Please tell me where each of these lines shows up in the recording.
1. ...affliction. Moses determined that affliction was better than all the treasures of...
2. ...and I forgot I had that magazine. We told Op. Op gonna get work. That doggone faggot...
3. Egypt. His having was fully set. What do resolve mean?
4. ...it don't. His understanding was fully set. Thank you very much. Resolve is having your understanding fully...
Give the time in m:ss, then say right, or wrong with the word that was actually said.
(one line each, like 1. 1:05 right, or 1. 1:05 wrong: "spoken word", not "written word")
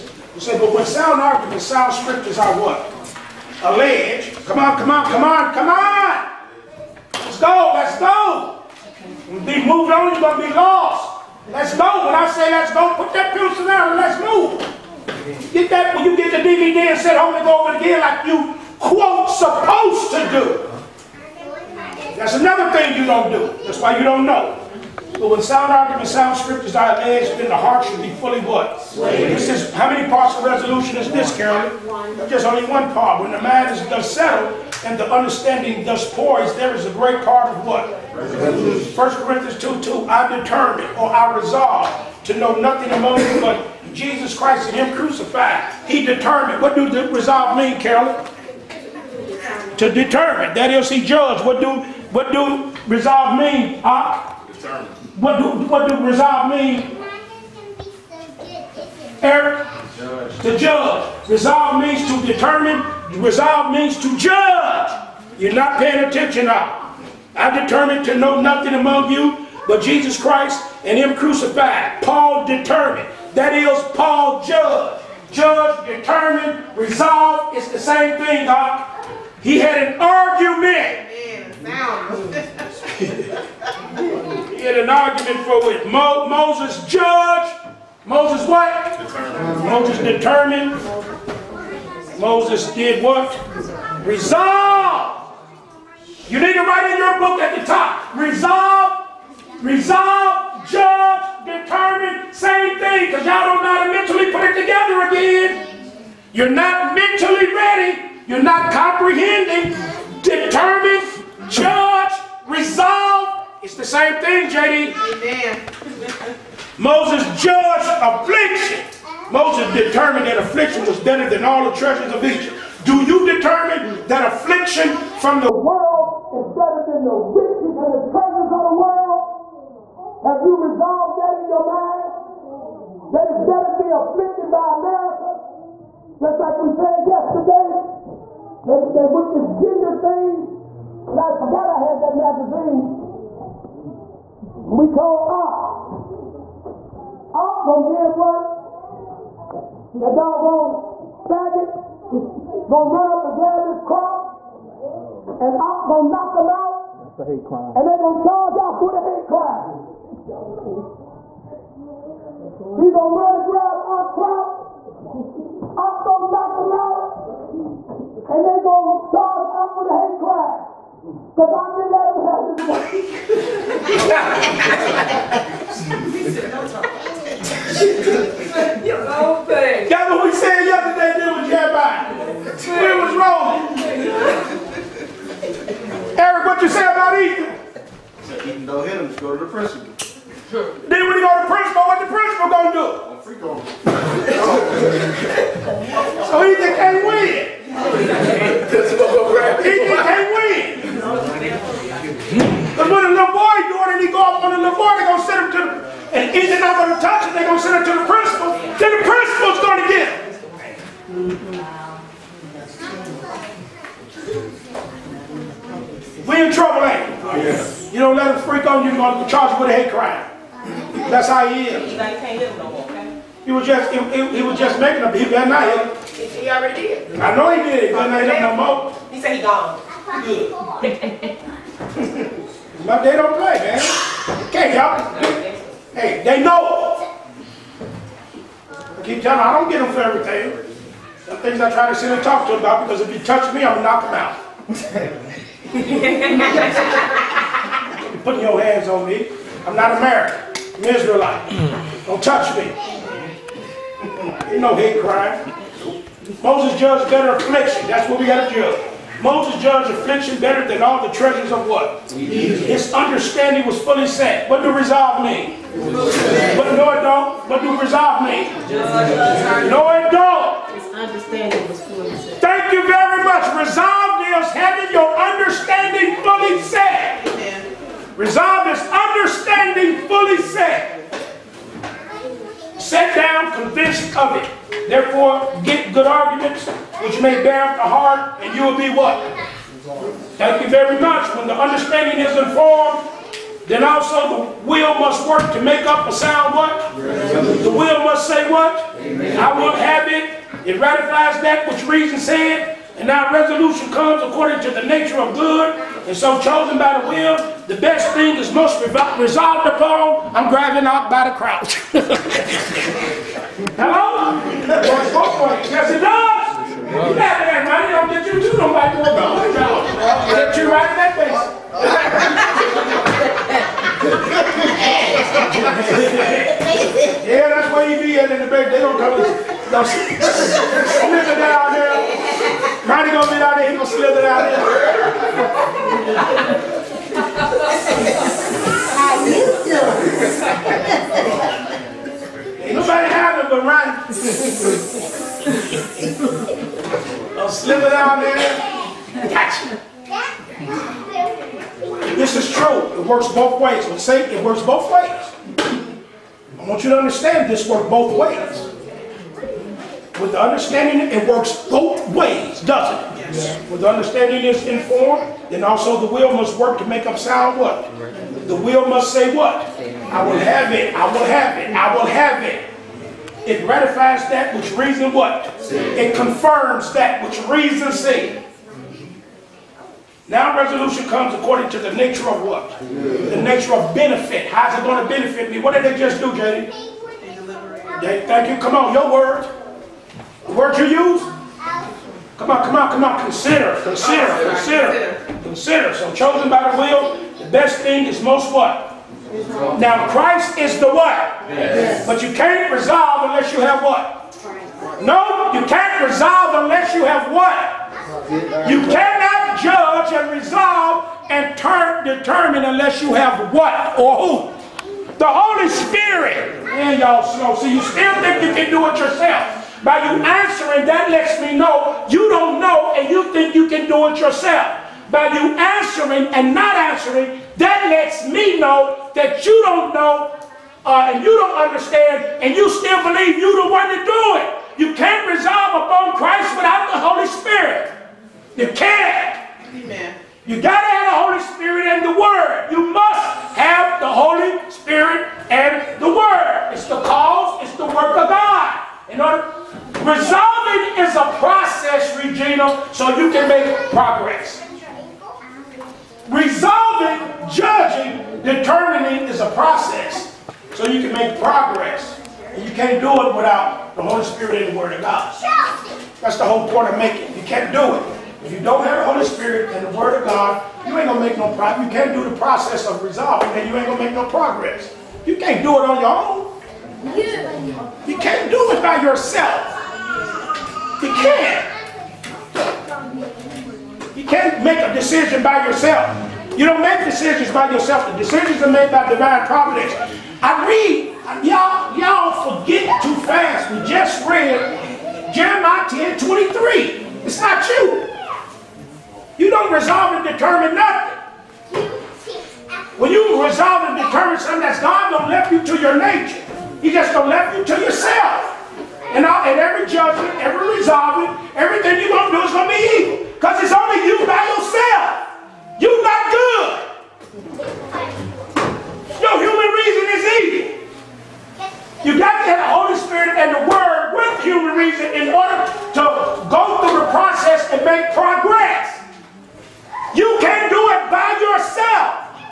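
1. 1:58 right
2. 2:21 right
3. 4:22 wrong: "understanding", not "having"
4. 4:29 right.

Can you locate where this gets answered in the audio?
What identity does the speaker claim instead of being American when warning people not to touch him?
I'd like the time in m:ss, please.
4:10.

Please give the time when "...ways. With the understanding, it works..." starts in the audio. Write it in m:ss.
5:58.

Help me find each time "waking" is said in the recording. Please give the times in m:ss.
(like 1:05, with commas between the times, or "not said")
not said.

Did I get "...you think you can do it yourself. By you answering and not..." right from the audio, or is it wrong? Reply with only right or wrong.
right.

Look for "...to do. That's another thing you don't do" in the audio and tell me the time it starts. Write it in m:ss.
0:20.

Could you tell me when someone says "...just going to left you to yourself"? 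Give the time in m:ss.
8:26.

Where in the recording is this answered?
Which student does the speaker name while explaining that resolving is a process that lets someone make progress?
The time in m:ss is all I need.
7:32.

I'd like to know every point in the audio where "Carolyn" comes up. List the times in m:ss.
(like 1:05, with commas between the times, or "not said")
0:31, 0:47.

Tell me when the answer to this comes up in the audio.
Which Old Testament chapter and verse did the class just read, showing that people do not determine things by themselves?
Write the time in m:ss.
8:15.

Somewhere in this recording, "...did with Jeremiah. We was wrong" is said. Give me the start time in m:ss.
3:01.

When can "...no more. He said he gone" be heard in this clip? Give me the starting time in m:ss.
3:48.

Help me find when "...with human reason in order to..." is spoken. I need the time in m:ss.
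8:44.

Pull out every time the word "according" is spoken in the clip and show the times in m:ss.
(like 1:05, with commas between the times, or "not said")
5:04, 6:21.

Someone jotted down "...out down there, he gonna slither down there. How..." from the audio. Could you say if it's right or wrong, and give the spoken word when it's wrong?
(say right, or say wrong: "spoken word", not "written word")
right.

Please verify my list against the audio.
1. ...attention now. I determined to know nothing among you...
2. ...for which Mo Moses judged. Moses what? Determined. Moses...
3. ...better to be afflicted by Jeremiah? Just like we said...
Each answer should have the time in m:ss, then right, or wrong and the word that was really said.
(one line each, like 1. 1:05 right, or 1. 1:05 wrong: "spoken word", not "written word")
1. 1:06 right
2. 1:25 right
3. 2:13 wrong: "America", not "Jeremiah".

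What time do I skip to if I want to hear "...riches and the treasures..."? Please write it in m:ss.
2:07.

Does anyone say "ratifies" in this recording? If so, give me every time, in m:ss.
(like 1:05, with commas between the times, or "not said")
5:00, 6:13.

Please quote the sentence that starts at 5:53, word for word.
When Satan, it works both ways.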